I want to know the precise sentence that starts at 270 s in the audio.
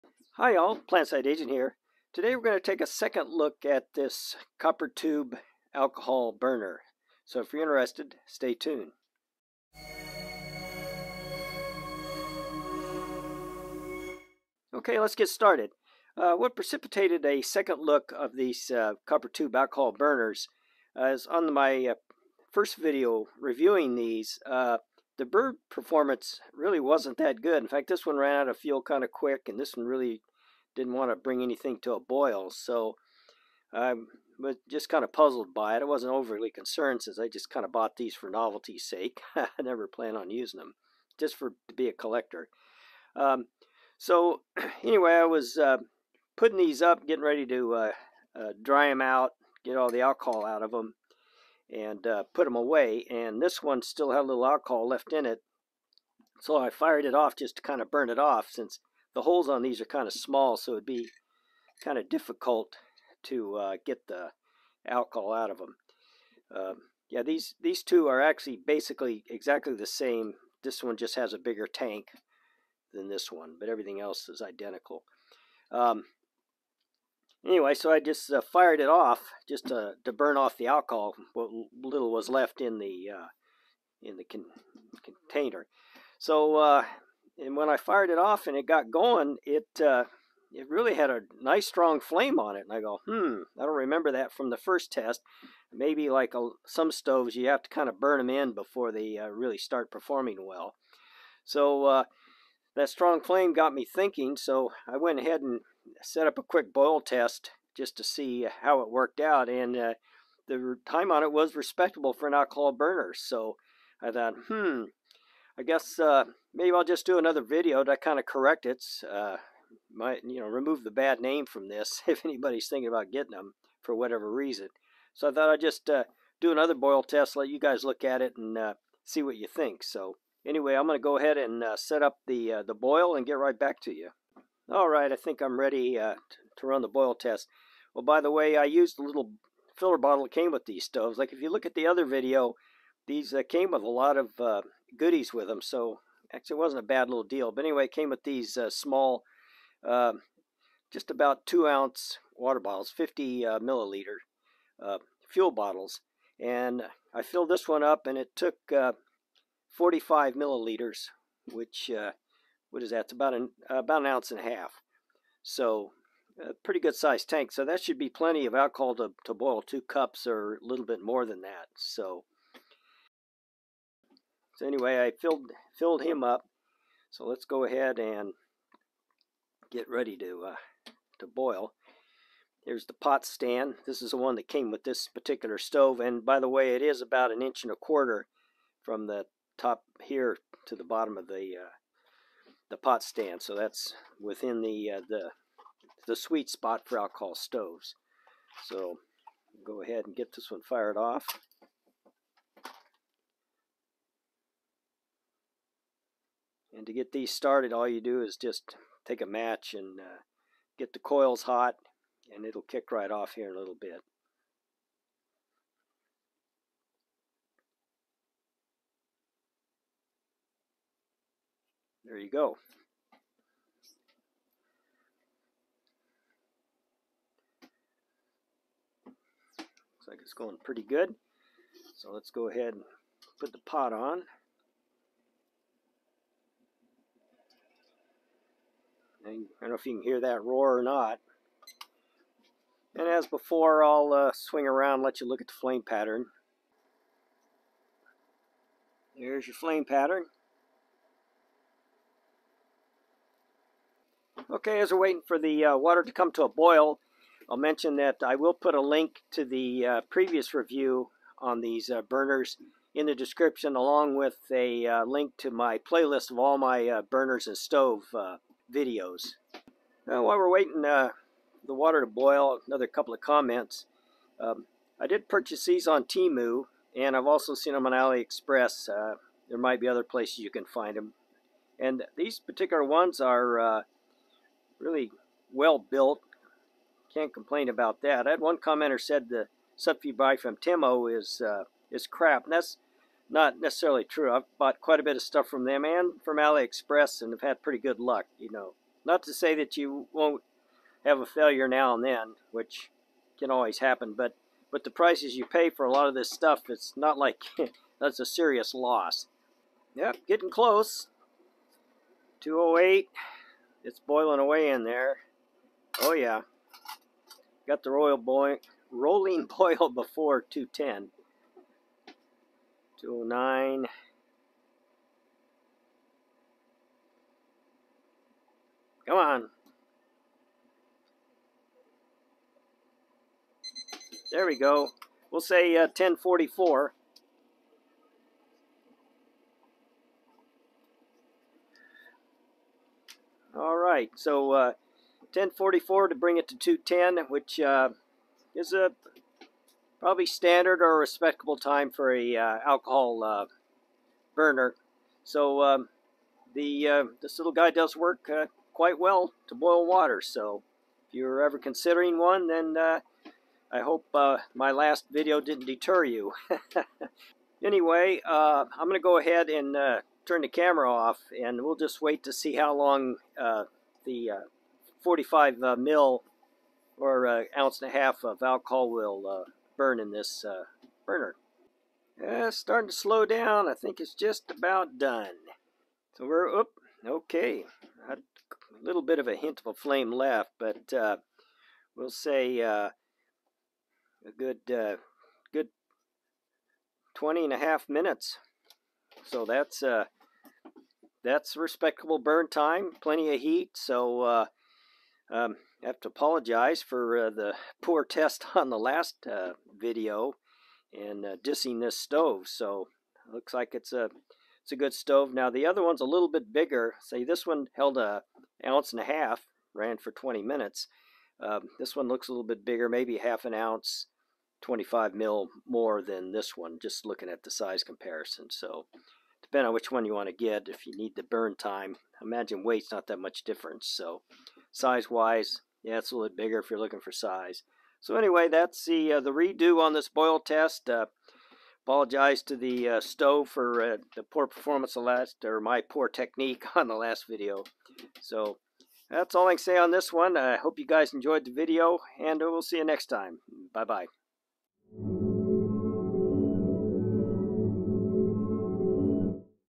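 Now, uh, while we're waiting uh, the water to boil, another couple of comments.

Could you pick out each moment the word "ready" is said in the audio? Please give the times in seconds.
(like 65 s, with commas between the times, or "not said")
47 s, 135 s, 179 s.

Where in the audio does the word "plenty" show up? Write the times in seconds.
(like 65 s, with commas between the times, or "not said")
168 s, 403 s.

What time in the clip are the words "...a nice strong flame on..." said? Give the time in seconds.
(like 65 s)
91 s.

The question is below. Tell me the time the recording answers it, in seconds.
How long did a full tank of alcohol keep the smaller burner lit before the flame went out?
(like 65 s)
397 s.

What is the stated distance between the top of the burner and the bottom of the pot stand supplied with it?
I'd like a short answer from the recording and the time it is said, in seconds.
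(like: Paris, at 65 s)
an inch and a quarter, at 187 s.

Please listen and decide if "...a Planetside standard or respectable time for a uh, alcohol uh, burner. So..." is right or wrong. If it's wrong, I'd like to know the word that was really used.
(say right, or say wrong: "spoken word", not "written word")
wrong: "Probably", not "Planetside".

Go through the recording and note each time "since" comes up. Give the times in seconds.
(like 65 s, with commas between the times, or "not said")
37 s, 58 s.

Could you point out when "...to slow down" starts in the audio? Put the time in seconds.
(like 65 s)
382 s.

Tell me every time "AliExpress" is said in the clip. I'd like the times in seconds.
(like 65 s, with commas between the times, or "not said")
277 s, 296 s.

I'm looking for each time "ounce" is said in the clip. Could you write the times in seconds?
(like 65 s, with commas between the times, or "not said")
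151 s, 164 s, 377 s, 418 s, 423 s.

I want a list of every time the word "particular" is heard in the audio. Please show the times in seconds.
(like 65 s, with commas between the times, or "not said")
185 s, 282 s.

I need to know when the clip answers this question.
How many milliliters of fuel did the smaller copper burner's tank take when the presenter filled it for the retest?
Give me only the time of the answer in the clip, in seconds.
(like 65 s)
159 s.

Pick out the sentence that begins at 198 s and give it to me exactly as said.
So go ahead and get this one fired off.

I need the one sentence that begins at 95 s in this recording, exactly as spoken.
Maybe like a, some stoves, you have to kind of burn them in before they uh, really start performing well.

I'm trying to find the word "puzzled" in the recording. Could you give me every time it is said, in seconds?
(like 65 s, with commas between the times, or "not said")
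35 s.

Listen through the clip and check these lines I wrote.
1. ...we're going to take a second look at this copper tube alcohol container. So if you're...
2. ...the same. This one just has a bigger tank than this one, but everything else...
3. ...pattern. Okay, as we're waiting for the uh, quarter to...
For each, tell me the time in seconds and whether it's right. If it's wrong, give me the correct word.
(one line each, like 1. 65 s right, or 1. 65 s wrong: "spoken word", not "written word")
1. 2 s wrong: "burner", not "container"
2. 69 s right
3. 249 s wrong: "water", not "quarter".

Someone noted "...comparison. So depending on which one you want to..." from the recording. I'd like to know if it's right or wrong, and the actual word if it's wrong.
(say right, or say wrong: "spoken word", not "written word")
right.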